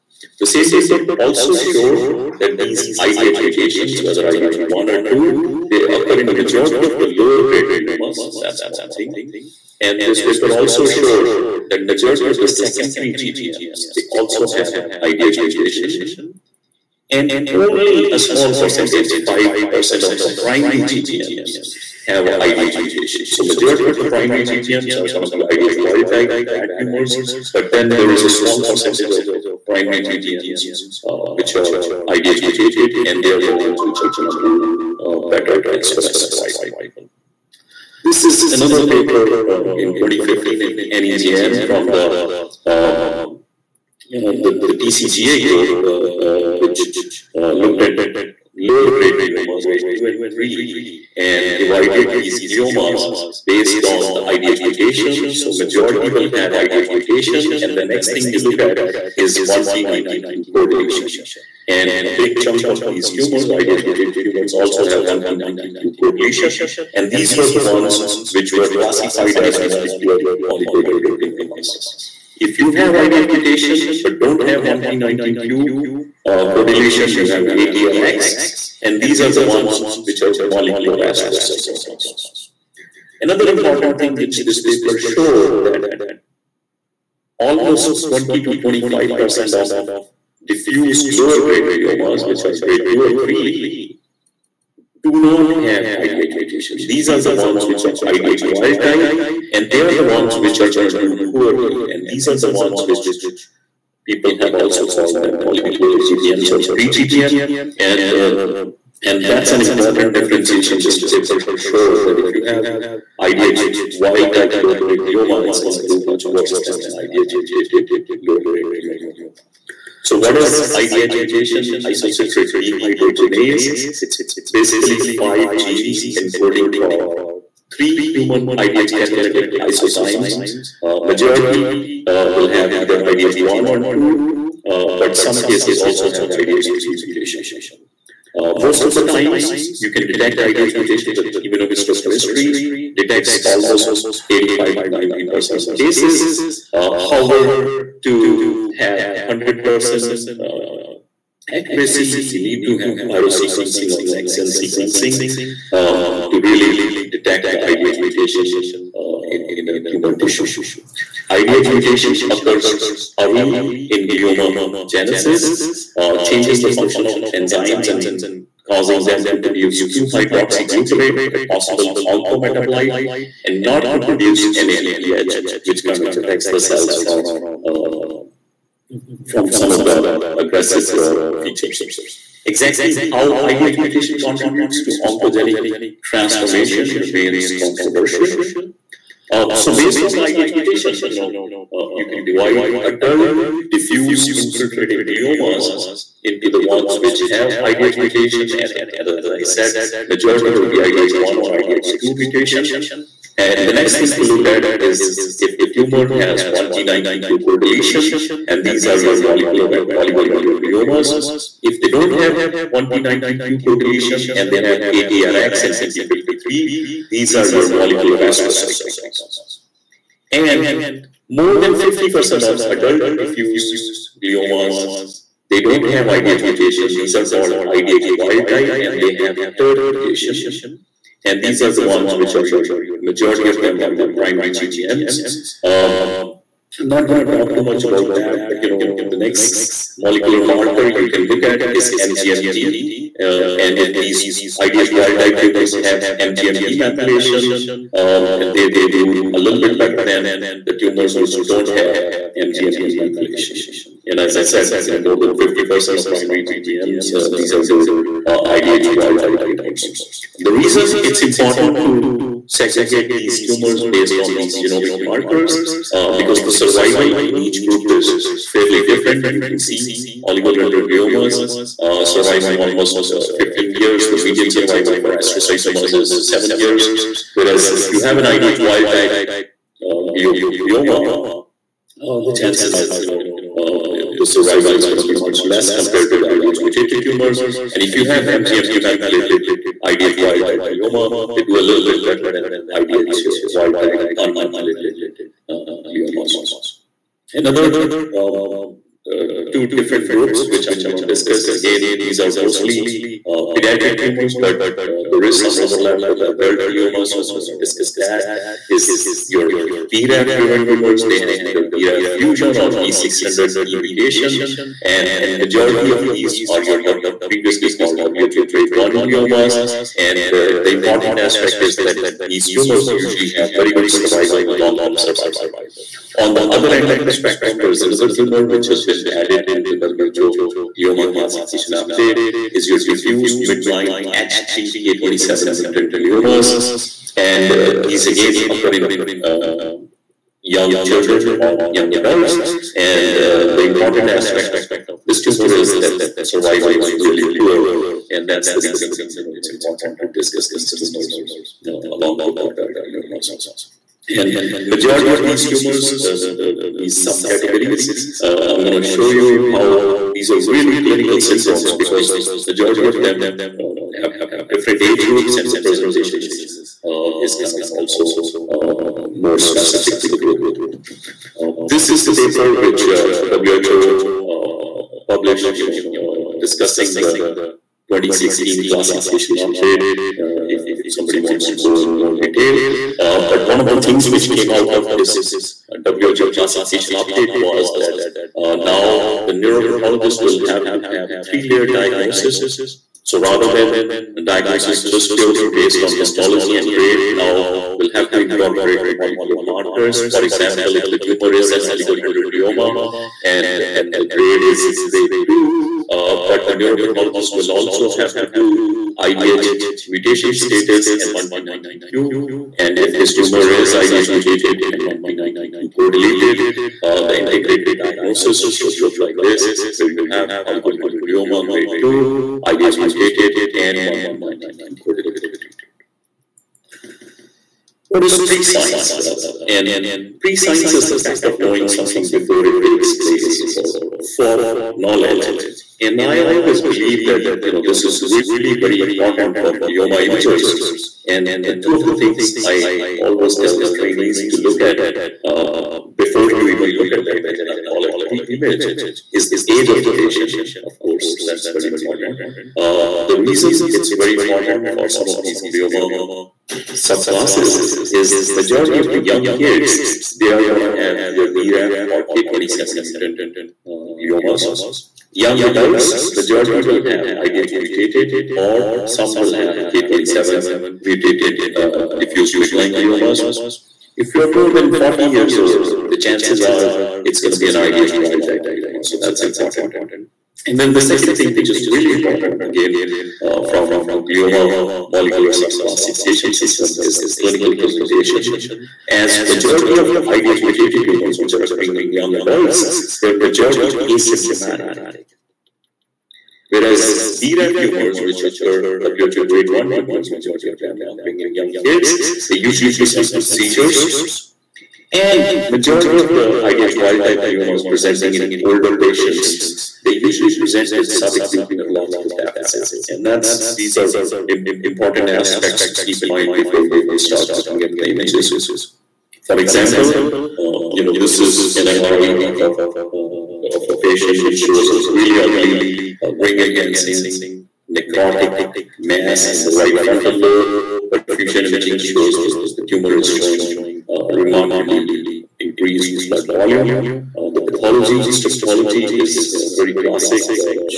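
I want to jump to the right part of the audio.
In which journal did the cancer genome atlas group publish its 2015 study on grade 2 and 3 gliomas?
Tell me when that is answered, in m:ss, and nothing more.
0:40.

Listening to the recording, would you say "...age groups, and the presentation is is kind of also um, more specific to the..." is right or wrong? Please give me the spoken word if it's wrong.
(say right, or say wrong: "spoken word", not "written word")
right.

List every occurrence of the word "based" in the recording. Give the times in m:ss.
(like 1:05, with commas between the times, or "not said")
0:53, 3:09, 4:23, 6:35.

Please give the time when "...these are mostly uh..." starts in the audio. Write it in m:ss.
5:02.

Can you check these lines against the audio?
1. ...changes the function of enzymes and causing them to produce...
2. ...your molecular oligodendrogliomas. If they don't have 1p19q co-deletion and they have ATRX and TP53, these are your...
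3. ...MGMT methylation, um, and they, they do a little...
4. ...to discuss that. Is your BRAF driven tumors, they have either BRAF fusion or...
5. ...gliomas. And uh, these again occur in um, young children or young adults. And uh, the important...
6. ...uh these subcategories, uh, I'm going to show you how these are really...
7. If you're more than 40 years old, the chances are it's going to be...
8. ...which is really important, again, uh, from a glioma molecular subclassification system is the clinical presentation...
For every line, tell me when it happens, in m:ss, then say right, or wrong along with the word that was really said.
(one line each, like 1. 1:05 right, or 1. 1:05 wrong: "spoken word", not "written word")
1. 2:46 right
2. 3:29 right
3. 4:06 right
4. 5:07 right
5. 5:35 right
6. 5:56 right
7. 7:53 right
8. 8:01 right.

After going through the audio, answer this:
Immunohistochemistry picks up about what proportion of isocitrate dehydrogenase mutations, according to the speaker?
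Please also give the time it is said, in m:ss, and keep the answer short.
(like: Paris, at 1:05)
85 to 90 percent, at 2:24.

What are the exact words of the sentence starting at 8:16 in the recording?
Whereas BRAF tumors, which occur WHO grade 1 tumors, majority of them occurring in young kids, they usually present with seizures.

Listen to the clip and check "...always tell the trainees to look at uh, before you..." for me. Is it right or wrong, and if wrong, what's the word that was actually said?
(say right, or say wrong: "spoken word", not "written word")
right.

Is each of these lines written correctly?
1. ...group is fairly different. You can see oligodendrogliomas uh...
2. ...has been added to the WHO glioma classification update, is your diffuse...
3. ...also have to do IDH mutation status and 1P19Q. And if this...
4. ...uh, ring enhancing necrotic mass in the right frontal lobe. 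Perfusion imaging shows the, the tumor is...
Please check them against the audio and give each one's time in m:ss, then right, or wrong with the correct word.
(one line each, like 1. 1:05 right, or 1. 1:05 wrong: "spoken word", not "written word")
1. 4:27 right
2. 5:28 right
3. 6:47 right
4. 8:46 right.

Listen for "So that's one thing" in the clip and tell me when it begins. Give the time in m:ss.
0:08.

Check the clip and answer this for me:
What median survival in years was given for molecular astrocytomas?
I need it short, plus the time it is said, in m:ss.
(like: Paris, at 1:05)
7 years, at 4:36.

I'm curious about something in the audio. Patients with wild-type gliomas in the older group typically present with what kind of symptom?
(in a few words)
subacute neurological deficit.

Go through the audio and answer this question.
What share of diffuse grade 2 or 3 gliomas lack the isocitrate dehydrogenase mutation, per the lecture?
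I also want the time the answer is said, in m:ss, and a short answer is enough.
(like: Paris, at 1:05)
20 to 25 percent, at 1:28.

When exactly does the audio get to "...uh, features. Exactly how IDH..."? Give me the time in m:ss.
3:00.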